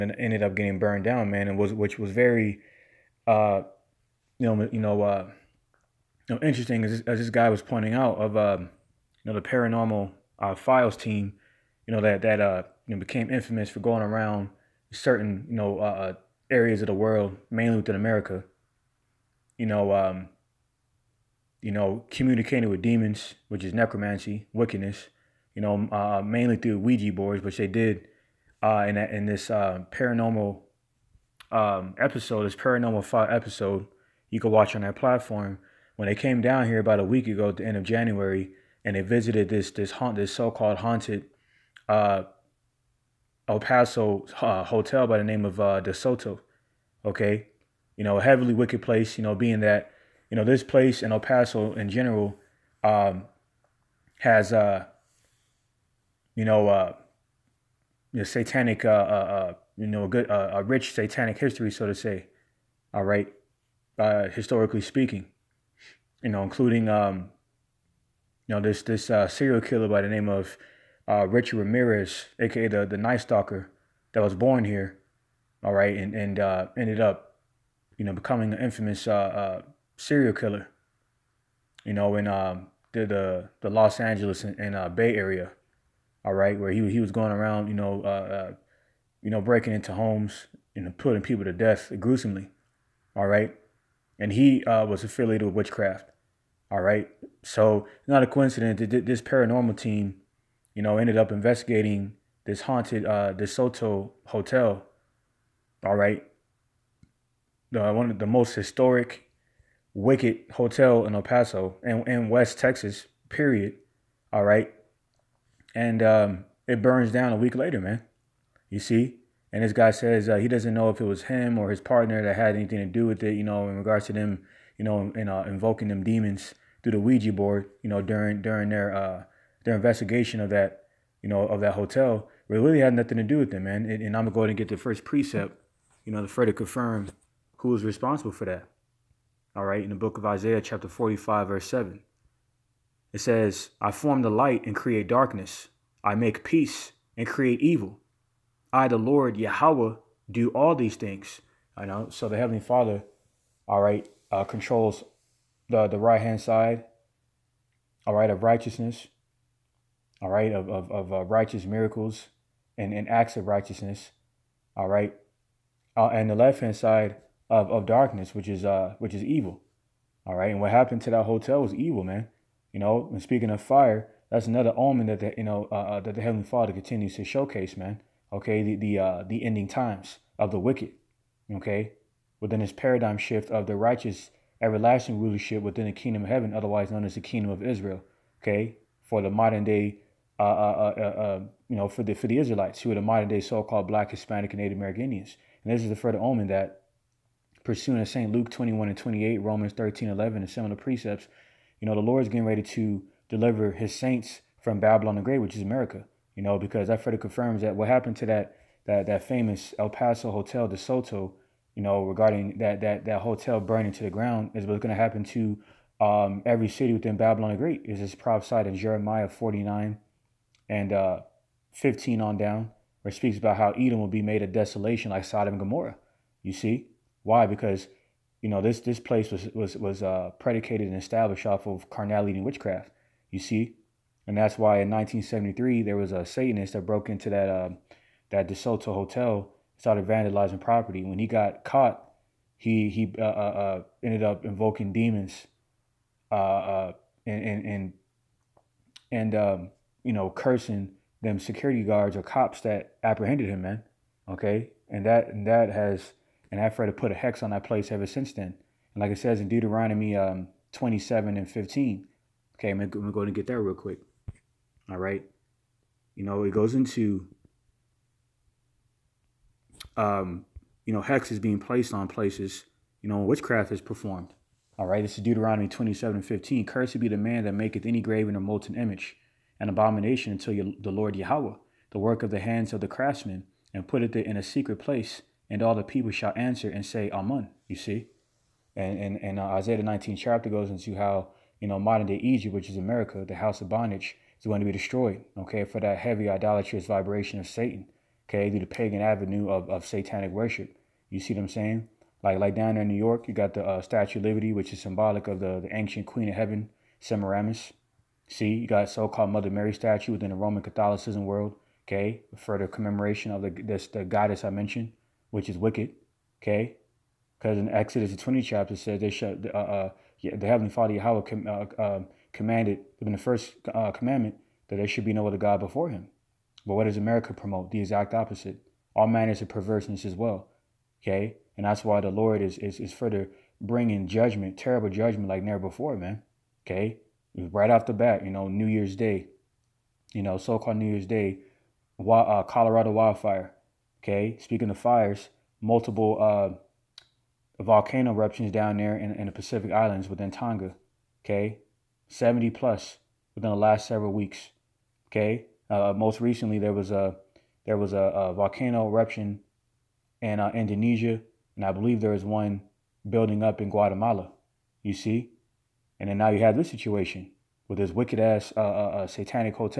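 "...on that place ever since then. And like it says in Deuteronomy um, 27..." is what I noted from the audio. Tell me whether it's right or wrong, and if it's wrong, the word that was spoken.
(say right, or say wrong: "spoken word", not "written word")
right.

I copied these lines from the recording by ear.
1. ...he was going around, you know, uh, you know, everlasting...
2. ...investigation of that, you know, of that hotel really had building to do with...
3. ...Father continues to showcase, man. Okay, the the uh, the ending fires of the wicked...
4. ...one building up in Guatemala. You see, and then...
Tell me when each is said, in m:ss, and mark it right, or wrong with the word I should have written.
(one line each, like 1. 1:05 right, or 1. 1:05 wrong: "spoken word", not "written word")
1. 1:26 wrong: "breaking", not "everlasting"
2. 2:09 wrong: "nothing", not "building"
3. 2:56 wrong: "times", not "fires"
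4. 6:02 right.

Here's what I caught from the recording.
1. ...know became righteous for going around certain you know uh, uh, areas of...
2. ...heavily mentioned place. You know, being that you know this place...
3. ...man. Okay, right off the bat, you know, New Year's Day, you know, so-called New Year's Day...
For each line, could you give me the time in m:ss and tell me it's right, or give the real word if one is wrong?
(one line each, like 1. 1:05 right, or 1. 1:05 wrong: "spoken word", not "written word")
1. 0:12 wrong: "infamous", not "righteous"
2. 0:48 wrong: "wicked", not "mentioned"
3. 5:35 right.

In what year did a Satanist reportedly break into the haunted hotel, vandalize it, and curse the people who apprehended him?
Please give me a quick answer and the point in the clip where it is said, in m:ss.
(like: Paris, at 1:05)
1973, at 3:54.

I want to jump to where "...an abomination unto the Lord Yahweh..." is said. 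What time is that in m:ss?
4:39.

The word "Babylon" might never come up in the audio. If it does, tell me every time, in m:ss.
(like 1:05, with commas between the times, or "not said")
3:24, 3:37.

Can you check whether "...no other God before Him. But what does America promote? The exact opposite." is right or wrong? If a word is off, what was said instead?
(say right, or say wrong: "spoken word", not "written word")
right.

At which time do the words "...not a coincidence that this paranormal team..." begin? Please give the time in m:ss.
1:38.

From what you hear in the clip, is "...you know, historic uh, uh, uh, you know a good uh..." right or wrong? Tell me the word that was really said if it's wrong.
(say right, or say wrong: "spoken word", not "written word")
wrong: "satanic", not "historic".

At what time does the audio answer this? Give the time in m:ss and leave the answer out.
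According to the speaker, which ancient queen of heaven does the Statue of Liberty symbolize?
5:06.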